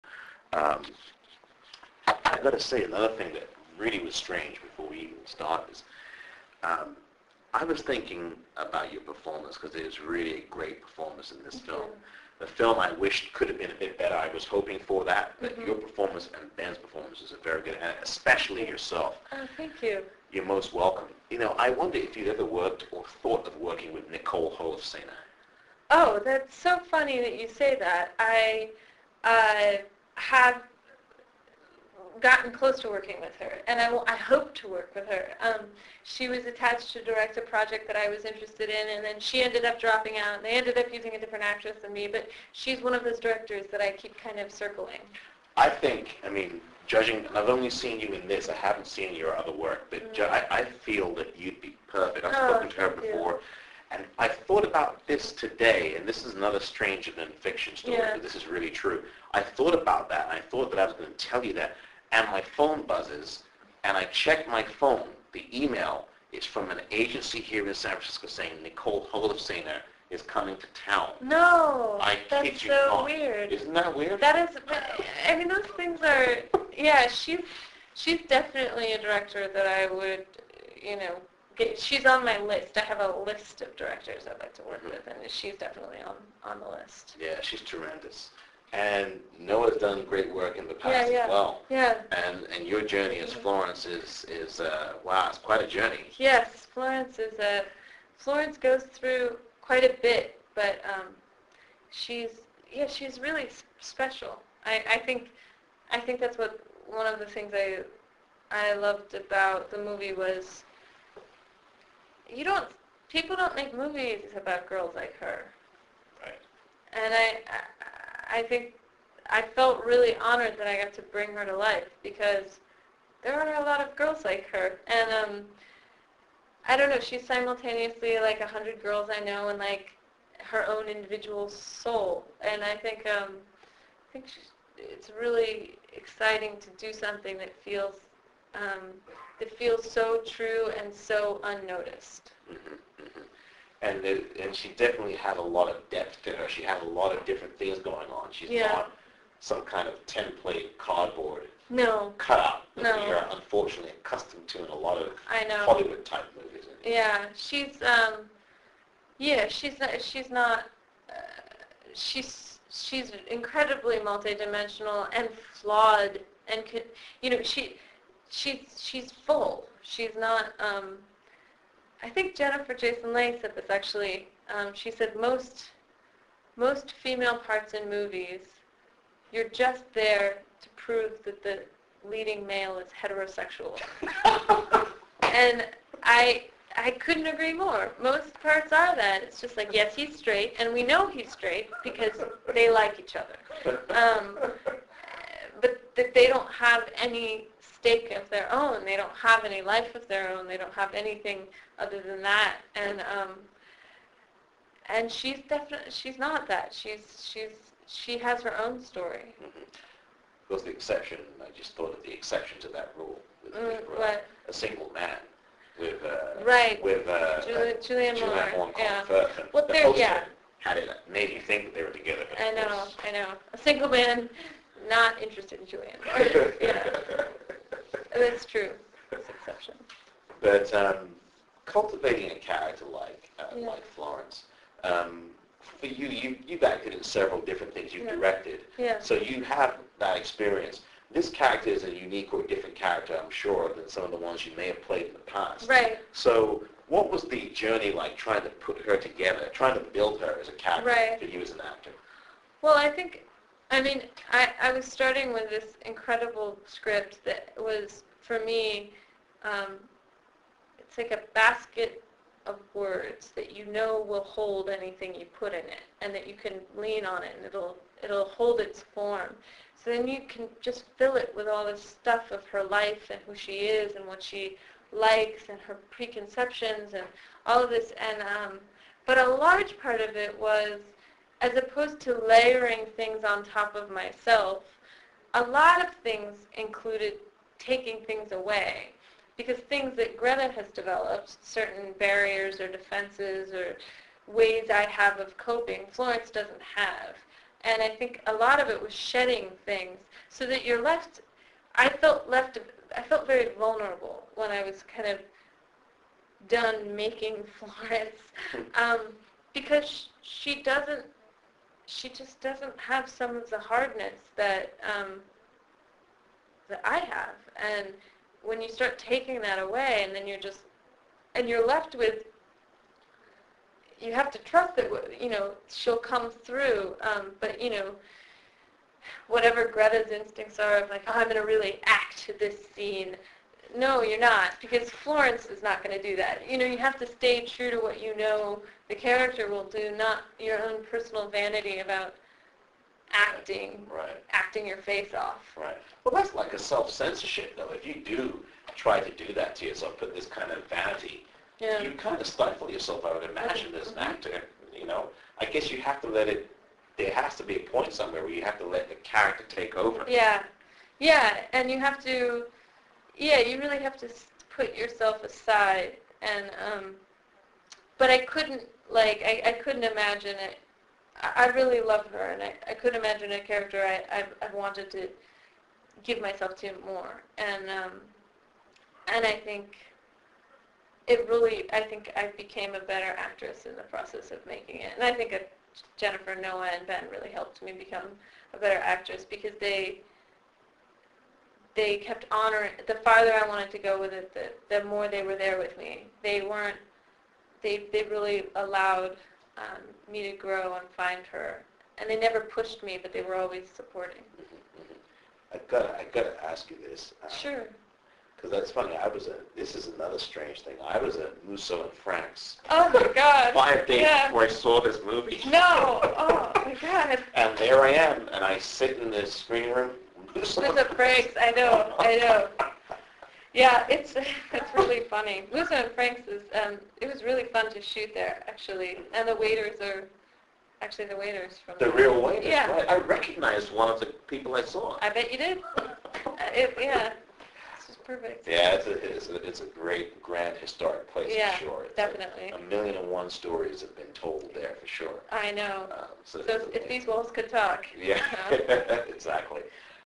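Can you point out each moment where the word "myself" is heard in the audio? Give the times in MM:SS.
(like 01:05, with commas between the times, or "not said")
04:43, 06:16.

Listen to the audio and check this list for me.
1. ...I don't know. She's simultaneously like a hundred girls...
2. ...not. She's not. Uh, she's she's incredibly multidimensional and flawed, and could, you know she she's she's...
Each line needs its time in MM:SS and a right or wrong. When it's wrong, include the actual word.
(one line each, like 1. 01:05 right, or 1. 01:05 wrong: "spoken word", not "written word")
1. 02:06 right
2. 02:39 right.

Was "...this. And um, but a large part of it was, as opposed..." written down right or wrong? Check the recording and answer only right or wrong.
right.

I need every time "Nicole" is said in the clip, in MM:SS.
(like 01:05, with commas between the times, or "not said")
00:24, 01:08.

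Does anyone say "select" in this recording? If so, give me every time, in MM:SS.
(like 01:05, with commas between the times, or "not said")
not said.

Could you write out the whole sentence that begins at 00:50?
ju- I, I feel that you'd be perfect.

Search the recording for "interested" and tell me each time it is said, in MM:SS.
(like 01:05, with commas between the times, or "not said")
00:38, 03:45.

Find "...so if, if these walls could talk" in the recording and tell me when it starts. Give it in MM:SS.
07:26.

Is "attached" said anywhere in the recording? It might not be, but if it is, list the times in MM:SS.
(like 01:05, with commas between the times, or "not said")
00:36.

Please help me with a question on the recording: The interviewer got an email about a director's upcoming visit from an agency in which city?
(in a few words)
San Francisco.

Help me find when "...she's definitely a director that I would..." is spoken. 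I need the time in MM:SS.
01:17.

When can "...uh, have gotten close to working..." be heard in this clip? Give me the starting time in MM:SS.
00:29.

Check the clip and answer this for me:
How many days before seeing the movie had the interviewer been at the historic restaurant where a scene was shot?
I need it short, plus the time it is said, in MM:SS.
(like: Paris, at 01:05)
5, at 06:53.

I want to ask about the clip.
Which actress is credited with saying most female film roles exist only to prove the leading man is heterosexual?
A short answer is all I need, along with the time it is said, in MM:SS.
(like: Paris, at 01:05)
Jennifer Jason Leigh, at 02:52.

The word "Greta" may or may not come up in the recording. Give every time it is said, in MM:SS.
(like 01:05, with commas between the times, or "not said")
04:50, 05:29.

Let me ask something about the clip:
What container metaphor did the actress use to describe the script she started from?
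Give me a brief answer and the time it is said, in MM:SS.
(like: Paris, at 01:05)
basket of words, at 04:21.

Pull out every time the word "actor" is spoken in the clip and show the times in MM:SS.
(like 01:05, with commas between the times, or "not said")
04:11, 05:53.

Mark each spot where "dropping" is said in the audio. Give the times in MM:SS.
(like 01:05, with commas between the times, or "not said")
00:39.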